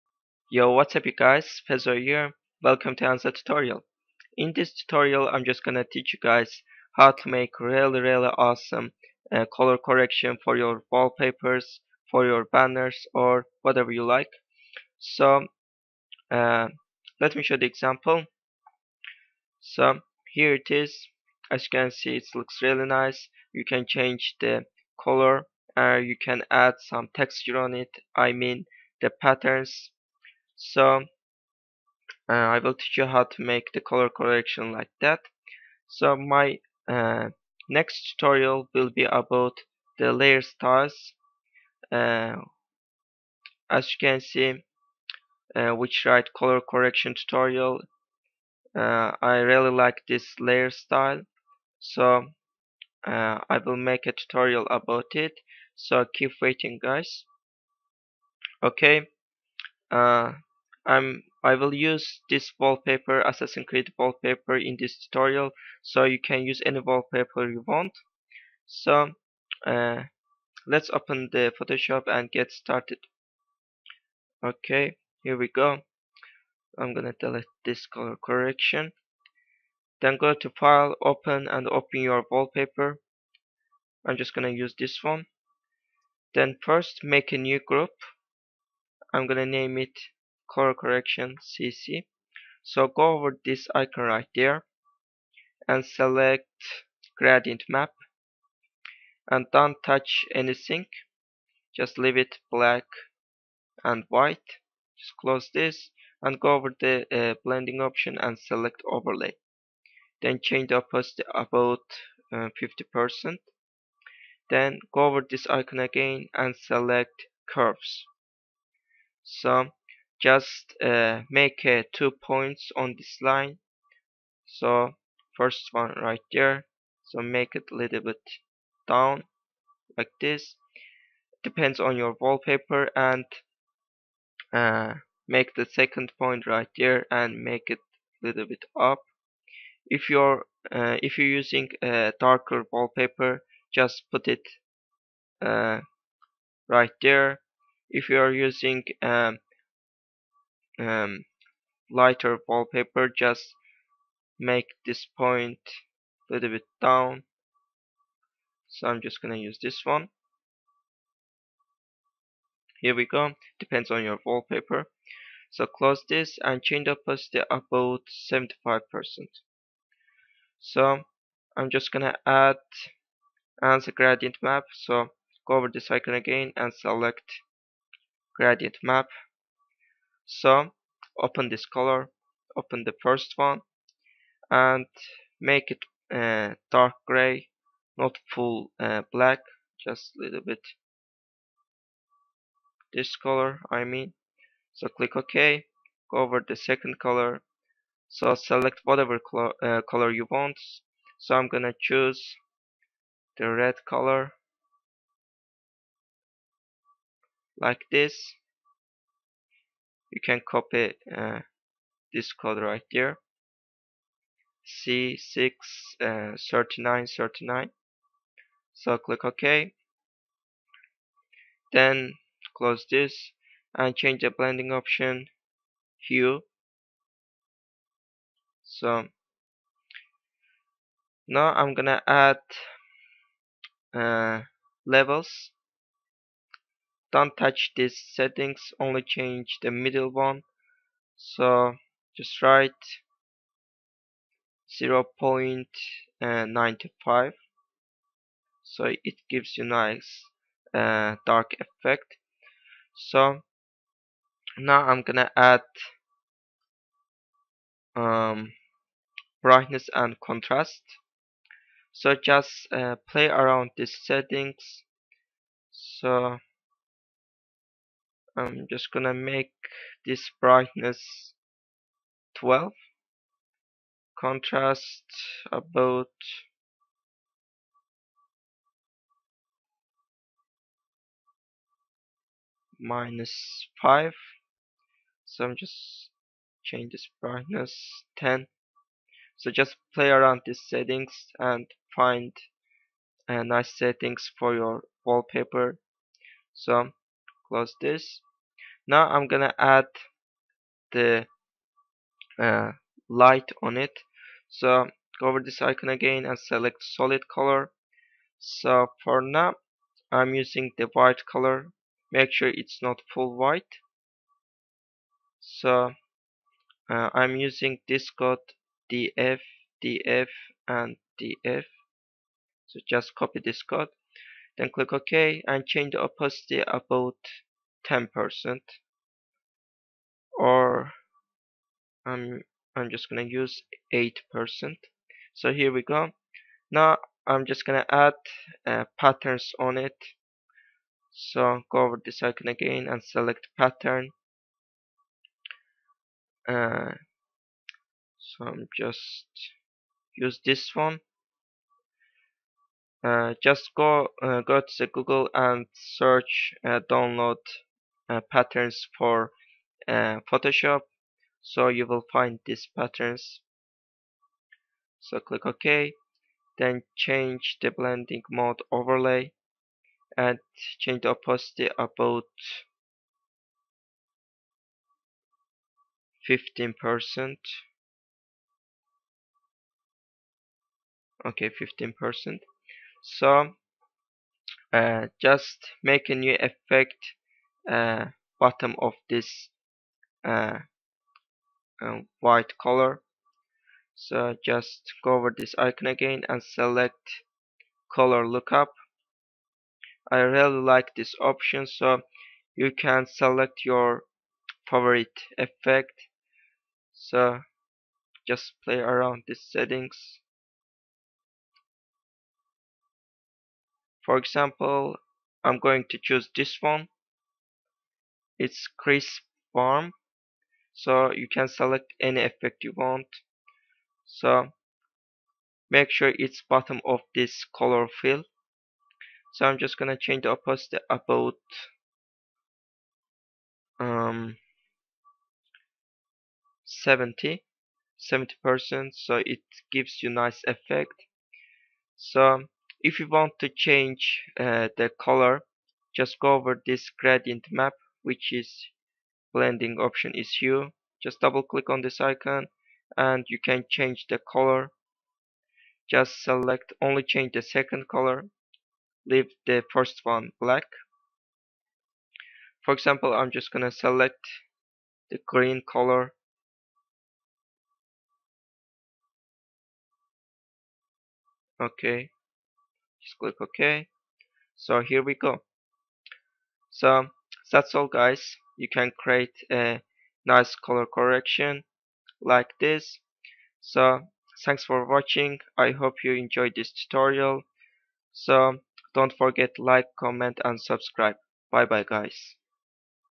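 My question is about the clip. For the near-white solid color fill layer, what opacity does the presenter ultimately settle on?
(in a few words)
8%.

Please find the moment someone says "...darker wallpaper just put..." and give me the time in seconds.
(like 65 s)
142 s.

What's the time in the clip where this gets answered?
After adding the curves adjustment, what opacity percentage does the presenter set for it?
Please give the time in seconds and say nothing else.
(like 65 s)
168 s.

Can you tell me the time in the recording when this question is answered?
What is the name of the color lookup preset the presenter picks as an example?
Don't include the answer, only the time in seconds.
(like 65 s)
418 s.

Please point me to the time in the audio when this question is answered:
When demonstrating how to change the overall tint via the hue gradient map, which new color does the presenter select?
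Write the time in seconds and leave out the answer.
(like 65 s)
465 s.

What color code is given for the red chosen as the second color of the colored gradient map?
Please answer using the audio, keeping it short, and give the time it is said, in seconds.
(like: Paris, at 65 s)
C6 39 39, at 214 s.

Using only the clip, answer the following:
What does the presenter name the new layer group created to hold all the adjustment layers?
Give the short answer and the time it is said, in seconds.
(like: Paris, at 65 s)
CC, at 91 s.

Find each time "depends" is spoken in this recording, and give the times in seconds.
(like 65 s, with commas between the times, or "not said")
131 s, 163 s.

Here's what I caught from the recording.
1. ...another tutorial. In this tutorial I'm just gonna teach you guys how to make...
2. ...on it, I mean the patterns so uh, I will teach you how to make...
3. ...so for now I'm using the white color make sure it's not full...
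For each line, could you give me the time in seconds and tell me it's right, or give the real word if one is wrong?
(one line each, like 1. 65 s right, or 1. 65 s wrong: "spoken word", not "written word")
1. 3 s right
2. 27 s right
3. 308 s right.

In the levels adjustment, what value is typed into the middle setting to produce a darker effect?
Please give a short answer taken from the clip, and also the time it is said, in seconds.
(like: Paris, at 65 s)
0.95, at 245 s.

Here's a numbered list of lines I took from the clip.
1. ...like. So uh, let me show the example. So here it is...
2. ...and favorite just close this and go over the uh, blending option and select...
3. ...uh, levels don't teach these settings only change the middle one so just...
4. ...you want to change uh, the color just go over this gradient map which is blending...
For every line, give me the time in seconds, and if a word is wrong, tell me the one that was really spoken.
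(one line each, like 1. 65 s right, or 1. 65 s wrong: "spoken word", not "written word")
1. 14 s right
2. 103 s wrong: "white", not "favorite"
3. 233 s wrong: "touch", not "teach"
4. 442 s right.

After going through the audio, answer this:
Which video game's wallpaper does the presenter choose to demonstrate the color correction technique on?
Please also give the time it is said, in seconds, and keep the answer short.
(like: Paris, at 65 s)
Assassin's Creed, at 63 s.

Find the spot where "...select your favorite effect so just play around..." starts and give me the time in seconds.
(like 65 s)
403 s.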